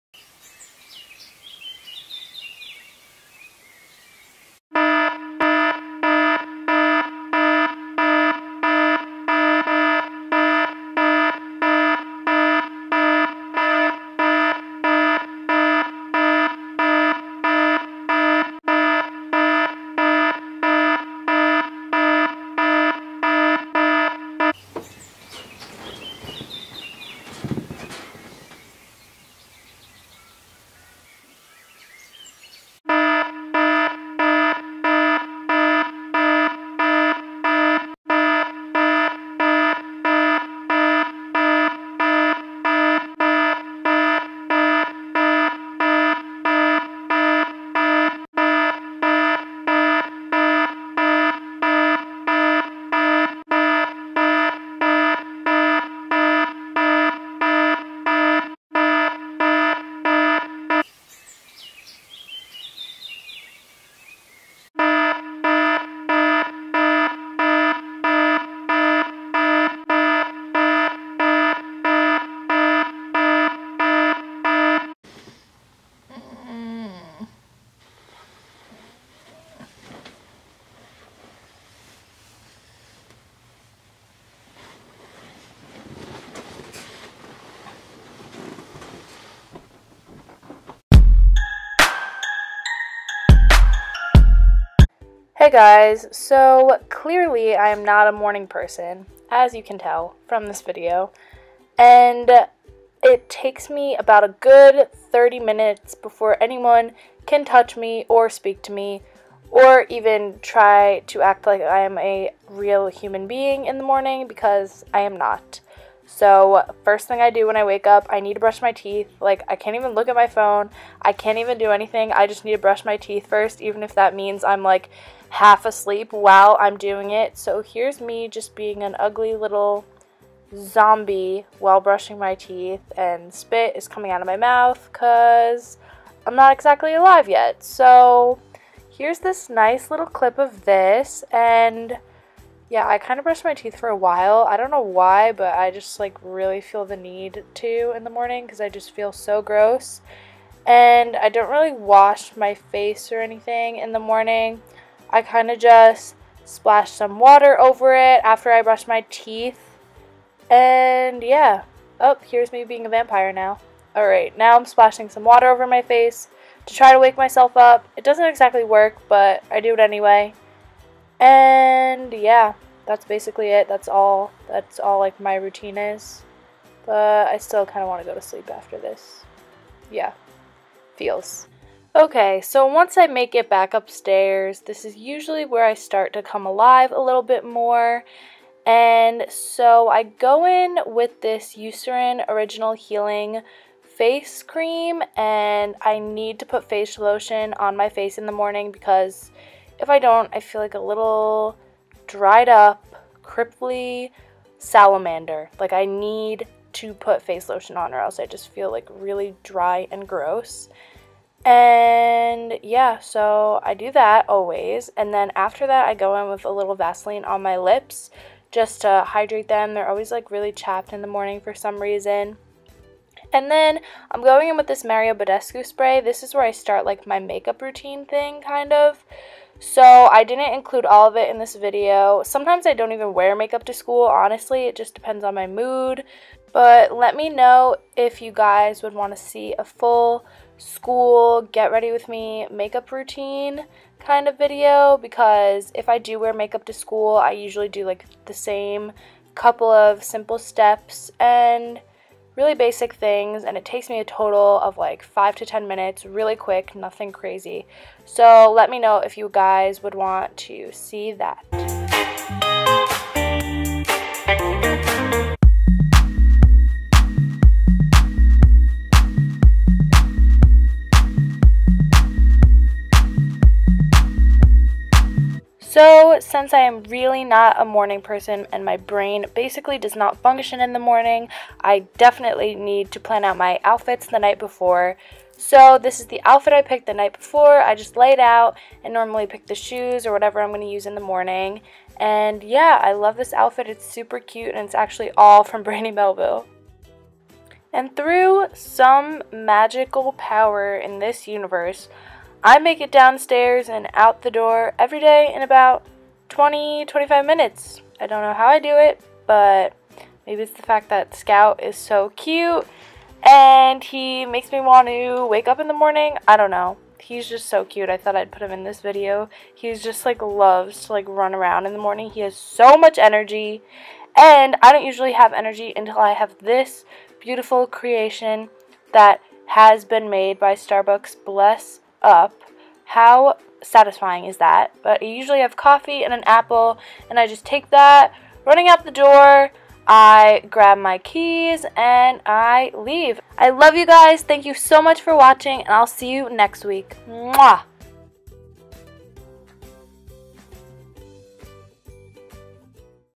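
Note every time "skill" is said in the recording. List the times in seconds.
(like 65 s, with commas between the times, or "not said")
not said.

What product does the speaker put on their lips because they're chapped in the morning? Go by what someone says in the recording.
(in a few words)
Vaseline.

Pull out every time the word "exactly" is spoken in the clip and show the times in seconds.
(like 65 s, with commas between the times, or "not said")
136 s, 168 s.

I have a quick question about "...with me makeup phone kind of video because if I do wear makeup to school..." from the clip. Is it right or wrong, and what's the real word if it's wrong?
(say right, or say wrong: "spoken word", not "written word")
wrong: "routine", not "phone".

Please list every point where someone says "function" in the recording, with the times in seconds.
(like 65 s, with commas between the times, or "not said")
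280 s.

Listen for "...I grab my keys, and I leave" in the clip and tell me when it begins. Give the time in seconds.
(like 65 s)
339 s.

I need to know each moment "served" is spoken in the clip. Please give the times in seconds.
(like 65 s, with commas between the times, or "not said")
not said.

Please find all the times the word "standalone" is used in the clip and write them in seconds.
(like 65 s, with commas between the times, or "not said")
not said.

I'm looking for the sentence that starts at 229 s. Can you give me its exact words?
So I didn't include all of it in this video.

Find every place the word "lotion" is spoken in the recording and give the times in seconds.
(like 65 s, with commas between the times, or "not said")
196 s, 207 s.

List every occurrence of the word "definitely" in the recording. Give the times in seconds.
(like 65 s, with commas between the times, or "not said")
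281 s.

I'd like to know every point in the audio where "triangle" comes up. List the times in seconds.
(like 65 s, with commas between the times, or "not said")
not said.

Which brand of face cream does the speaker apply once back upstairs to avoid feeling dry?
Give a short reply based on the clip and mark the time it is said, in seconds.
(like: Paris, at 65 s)
Eucerin, at 191 s.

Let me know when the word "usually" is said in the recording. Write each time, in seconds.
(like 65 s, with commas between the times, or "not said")
184 s, 247 s, 324 s, 335 s.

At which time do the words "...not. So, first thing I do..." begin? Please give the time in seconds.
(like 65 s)
115 s.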